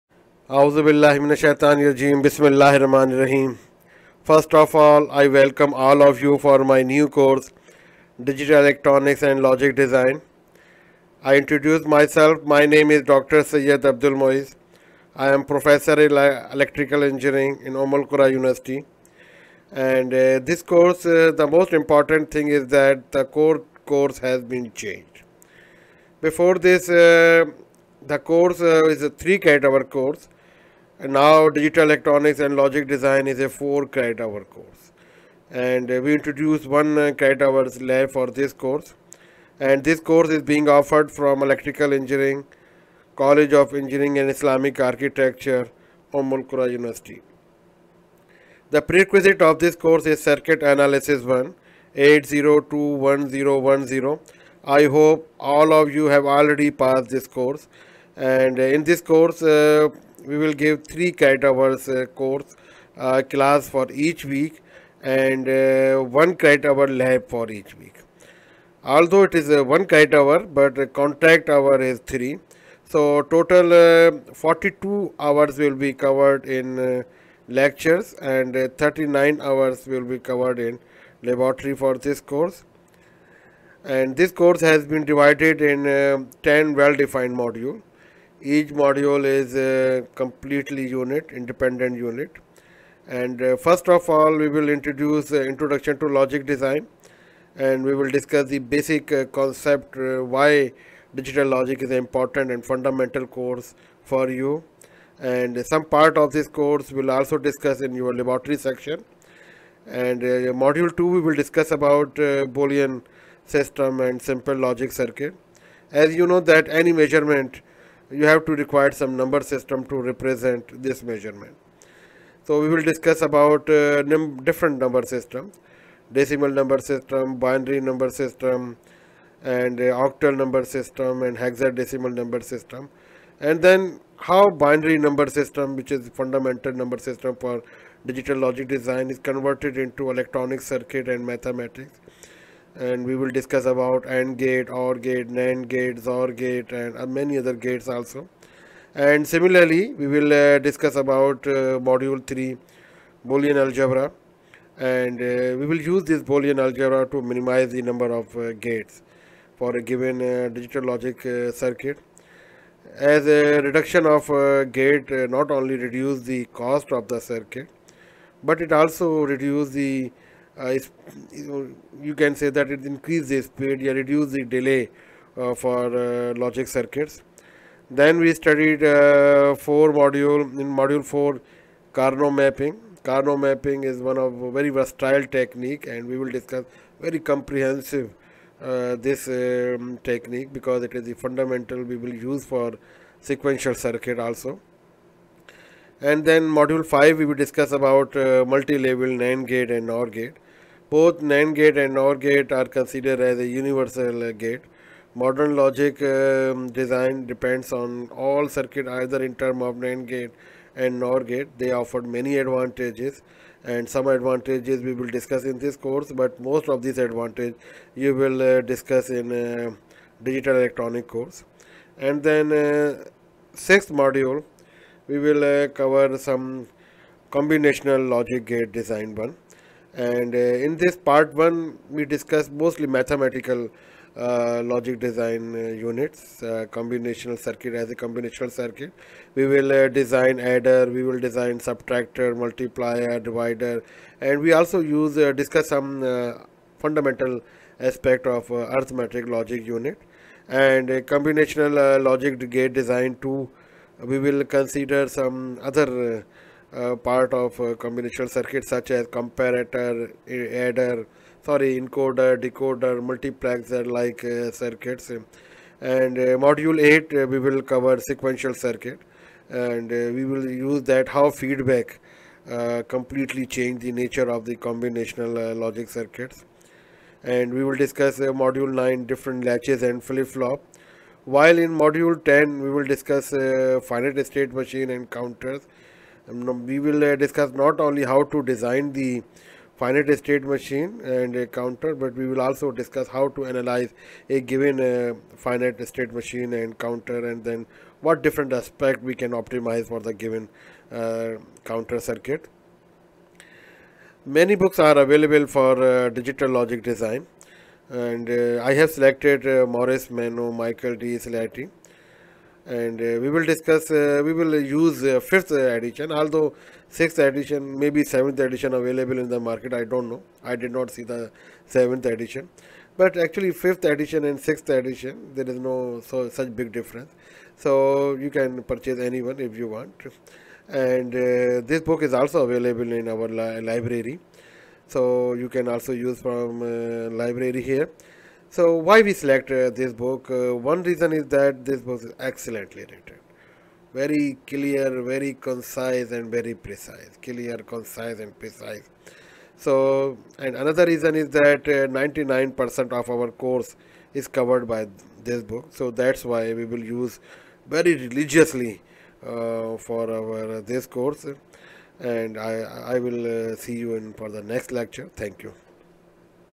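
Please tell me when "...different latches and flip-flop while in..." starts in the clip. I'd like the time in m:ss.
4:39.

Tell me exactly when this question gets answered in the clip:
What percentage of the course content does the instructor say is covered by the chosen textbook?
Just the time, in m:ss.
5:51.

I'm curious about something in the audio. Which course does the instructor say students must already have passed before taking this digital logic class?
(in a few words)
Circuit Analysis 1.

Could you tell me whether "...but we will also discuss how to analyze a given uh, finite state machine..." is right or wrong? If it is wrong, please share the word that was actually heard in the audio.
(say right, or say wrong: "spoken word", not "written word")
right.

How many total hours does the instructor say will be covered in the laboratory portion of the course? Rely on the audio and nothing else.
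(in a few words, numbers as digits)
39.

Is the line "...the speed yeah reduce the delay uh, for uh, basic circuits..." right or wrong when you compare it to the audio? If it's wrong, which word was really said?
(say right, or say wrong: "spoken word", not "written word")
wrong: "logic", not "basic".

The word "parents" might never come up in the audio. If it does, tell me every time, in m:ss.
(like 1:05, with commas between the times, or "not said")
not said.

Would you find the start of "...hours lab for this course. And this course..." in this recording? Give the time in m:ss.
0:37.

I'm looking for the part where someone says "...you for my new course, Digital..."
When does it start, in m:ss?
0:06.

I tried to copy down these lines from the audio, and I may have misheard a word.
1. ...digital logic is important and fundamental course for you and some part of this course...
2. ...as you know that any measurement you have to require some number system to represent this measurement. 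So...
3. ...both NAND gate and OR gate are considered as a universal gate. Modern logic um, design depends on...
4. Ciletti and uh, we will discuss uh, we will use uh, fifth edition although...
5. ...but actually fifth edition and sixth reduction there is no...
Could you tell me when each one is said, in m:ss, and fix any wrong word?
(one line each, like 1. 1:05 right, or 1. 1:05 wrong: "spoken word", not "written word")
1. 1:41 right
2. 1:55 right
3. 3:20 right
4. 5:11 right
5. 5:22 wrong: "edition", not "reduction".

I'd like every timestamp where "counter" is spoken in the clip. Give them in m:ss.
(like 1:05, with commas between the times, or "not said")
4:45, 4:51, 4:56, 5:01.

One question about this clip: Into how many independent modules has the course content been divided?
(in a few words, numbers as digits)
10.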